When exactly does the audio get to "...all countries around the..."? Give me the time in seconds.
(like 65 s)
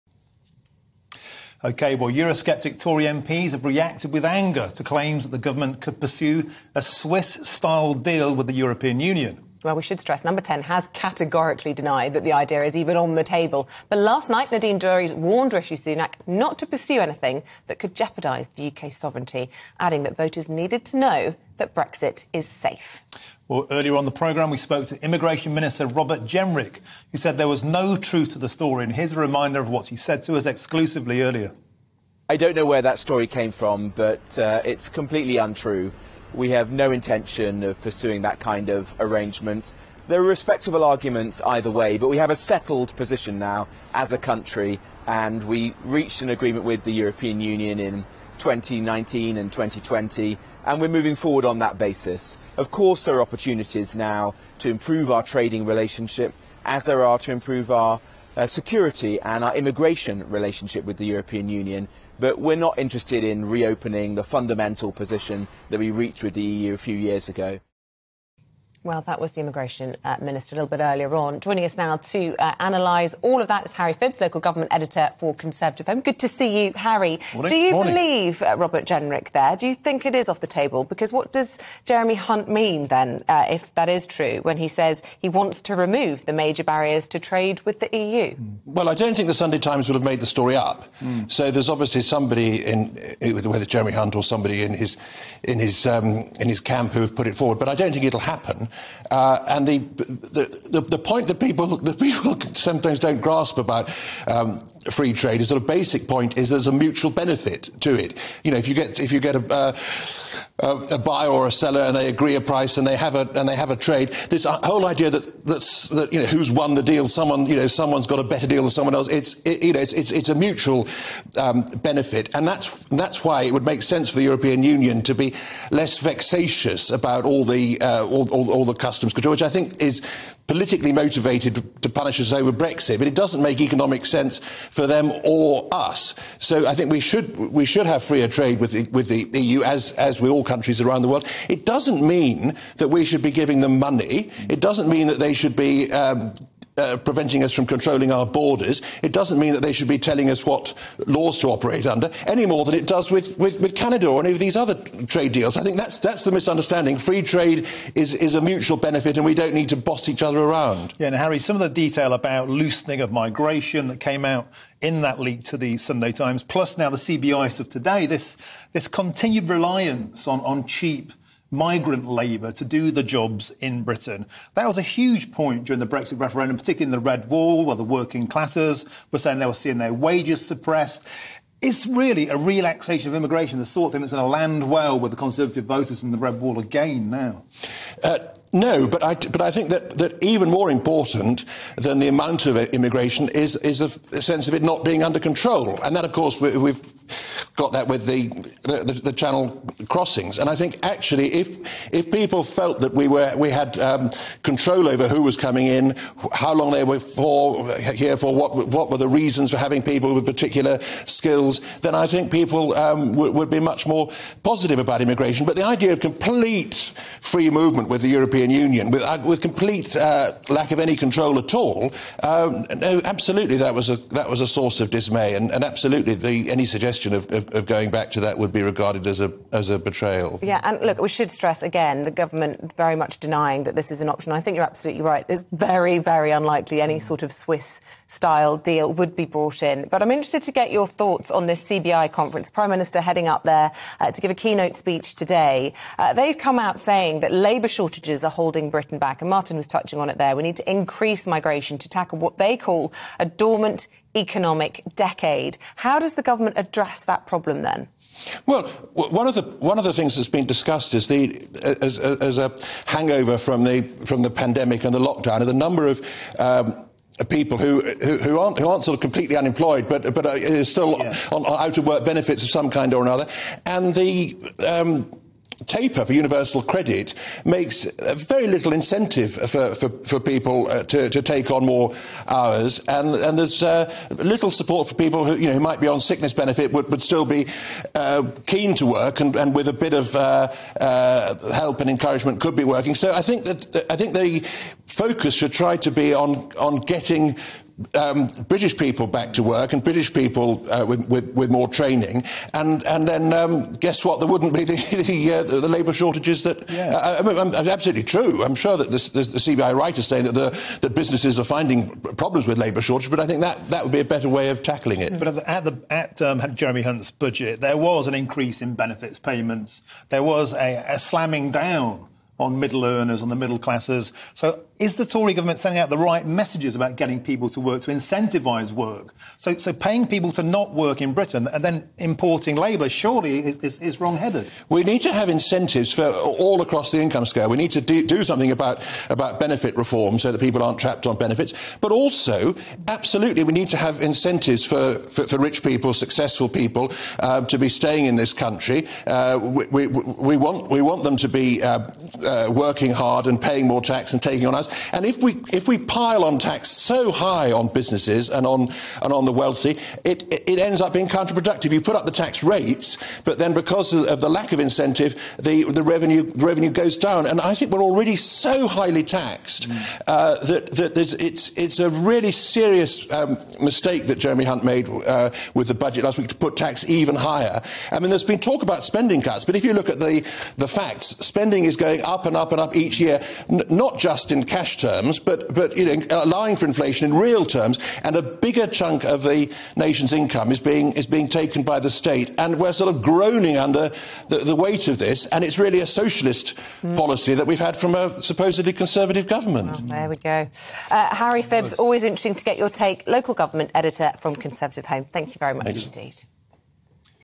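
140 s.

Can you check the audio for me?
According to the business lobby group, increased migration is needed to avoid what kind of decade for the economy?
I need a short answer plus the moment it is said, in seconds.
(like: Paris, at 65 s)
A dormant economic decade, at 253 s.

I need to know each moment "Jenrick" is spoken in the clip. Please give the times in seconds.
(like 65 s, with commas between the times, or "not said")
26 s, 78 s.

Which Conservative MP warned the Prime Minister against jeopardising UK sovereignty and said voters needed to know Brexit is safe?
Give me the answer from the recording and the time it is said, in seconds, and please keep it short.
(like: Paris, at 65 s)
Nadine Dorries, at 14 s.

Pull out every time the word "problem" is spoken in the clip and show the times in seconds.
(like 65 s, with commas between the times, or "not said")
257 s, 312 s.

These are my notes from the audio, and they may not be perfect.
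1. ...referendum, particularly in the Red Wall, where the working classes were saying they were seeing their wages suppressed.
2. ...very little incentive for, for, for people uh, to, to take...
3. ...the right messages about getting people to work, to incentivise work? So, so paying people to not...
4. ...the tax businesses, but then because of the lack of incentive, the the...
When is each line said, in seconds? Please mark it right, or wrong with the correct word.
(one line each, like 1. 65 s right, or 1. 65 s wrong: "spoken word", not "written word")
1. 176 s right
2. 278 s right
3. 325 s right
4. 362 s wrong: "rates", not "businesses".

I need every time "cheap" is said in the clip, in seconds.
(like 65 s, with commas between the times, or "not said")
170 s.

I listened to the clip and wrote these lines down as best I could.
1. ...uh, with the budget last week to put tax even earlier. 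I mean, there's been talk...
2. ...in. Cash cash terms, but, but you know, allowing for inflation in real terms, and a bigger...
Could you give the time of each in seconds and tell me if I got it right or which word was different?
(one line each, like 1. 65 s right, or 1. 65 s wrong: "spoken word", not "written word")
1. 374 s wrong: "higher", not "earlier"
2. 384 s right.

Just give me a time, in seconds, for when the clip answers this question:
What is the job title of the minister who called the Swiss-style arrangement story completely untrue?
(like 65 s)
25 s.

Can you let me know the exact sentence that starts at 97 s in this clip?
But I don't think it'll happen.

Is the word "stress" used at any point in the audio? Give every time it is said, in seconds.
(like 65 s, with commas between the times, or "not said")
10 s, 231 s.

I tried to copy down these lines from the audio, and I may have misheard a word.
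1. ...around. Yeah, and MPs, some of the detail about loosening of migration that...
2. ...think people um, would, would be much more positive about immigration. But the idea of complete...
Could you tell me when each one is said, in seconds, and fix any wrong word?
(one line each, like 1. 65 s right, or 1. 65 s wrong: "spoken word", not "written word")
1. 160 s wrong: "Harry", not "MPs"
2. 212 s right.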